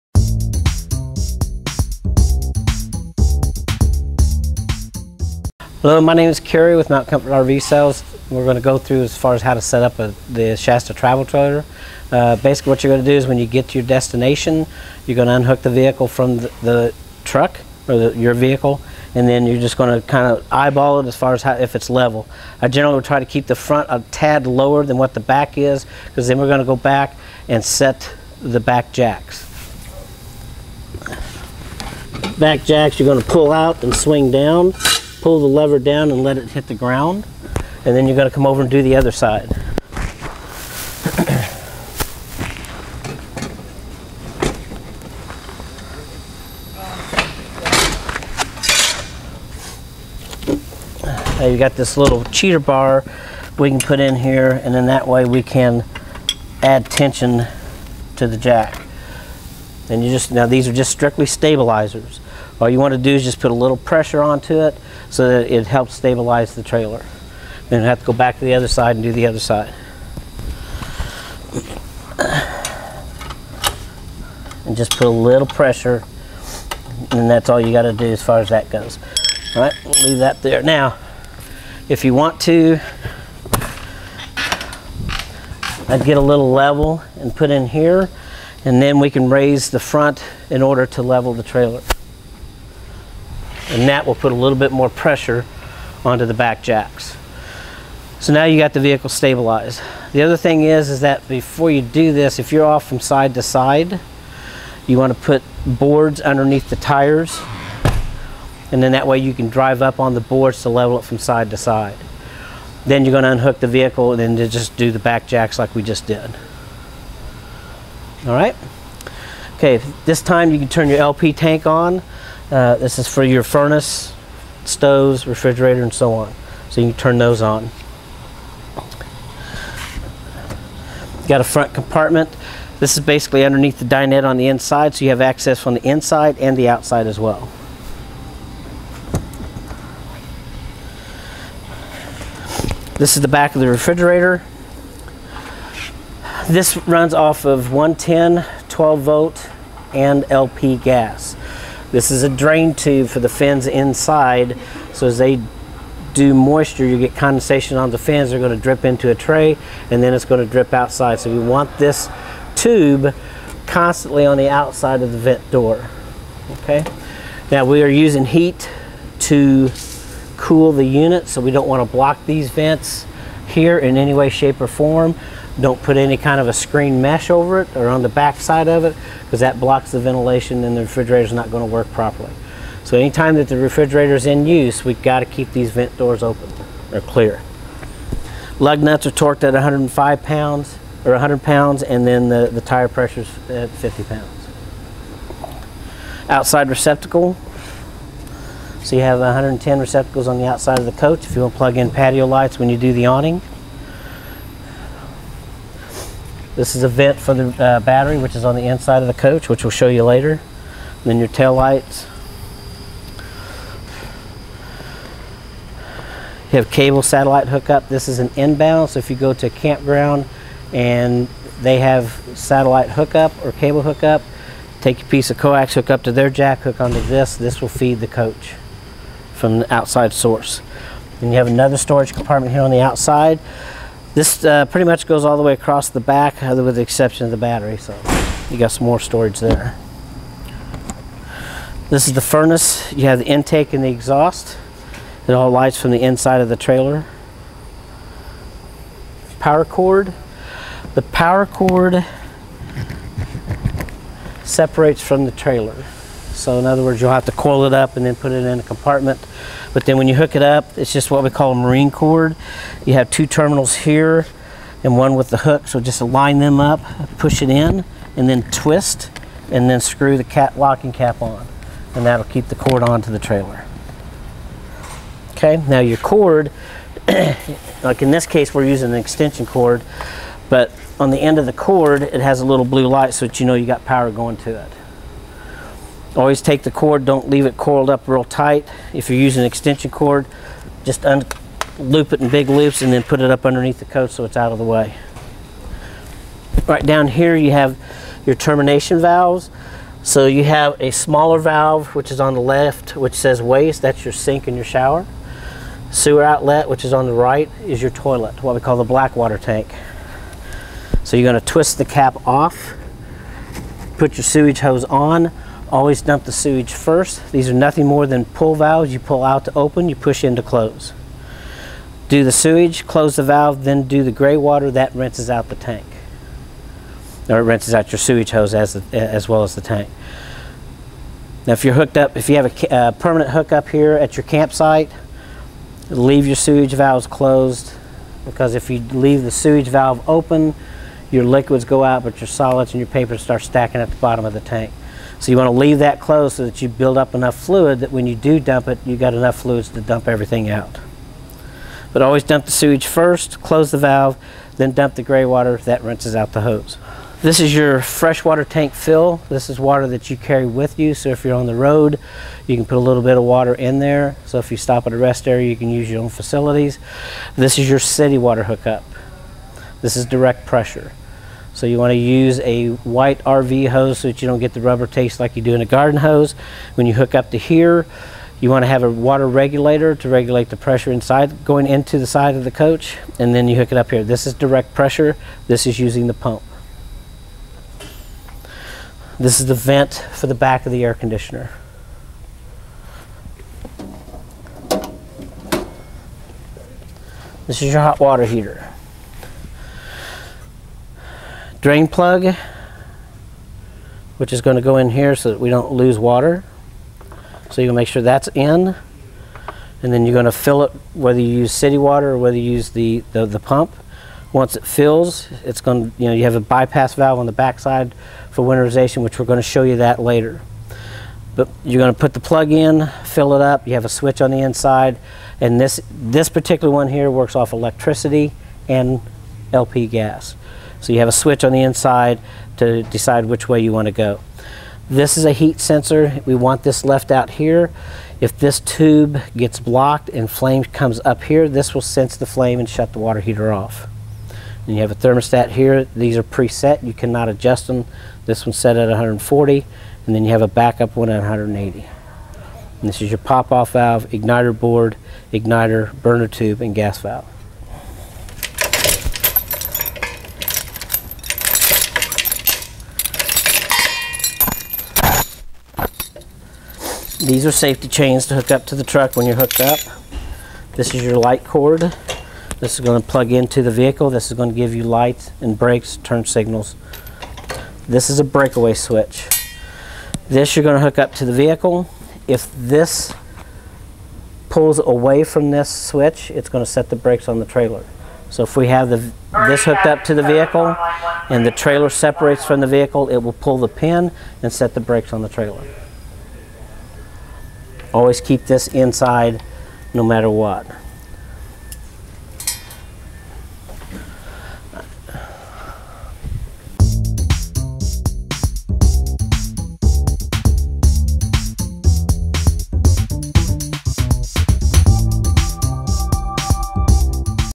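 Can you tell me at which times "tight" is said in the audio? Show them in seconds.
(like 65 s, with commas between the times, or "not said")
288 s.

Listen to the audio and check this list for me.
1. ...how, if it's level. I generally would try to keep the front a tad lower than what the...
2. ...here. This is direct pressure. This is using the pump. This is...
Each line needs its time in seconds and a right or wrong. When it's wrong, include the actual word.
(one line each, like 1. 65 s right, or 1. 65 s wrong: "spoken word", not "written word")
1. 21 s right
2. 383 s right.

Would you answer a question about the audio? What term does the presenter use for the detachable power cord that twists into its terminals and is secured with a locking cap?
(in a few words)
marine cord.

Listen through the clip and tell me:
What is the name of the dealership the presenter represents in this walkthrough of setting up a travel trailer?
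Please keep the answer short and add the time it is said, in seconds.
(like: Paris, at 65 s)
Mount Comfort RV Sales, at 6 s.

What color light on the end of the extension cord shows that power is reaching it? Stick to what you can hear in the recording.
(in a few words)
blue.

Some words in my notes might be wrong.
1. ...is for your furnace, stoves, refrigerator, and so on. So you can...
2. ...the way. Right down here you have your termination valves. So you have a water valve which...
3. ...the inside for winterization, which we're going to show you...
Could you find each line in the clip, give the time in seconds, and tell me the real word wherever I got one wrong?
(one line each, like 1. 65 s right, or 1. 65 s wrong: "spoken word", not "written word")
1. 122 s right
2. 294 s wrong: "smaller", not "water"
3. 417 s wrong: "backside", not "inside".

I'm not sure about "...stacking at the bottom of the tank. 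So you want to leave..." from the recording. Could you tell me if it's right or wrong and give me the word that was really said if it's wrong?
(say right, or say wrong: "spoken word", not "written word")
right.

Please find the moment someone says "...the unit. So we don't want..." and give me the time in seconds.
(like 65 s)
170 s.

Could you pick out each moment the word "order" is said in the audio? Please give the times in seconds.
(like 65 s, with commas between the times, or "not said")
90 s.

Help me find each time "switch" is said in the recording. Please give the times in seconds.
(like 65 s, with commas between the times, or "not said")
423 s, 431 s, 478 s, 485 s.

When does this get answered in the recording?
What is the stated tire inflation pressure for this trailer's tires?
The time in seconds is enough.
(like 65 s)
193 s.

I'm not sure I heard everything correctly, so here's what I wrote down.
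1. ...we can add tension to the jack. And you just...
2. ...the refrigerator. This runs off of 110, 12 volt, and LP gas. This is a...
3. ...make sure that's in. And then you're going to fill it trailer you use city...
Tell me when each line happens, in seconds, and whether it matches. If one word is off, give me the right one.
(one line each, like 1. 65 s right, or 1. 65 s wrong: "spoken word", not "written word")
1. 55 s right
2. 143 s right
3. 407 s wrong: "whether", not "trailer".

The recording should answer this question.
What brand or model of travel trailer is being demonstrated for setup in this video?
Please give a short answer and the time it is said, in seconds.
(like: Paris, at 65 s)
Shasta, at 10 s.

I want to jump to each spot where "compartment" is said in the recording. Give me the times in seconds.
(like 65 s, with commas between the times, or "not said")
131 s, 232 s, 258 s.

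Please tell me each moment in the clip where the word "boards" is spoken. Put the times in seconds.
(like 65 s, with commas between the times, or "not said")
105 s, 110 s, 454 s.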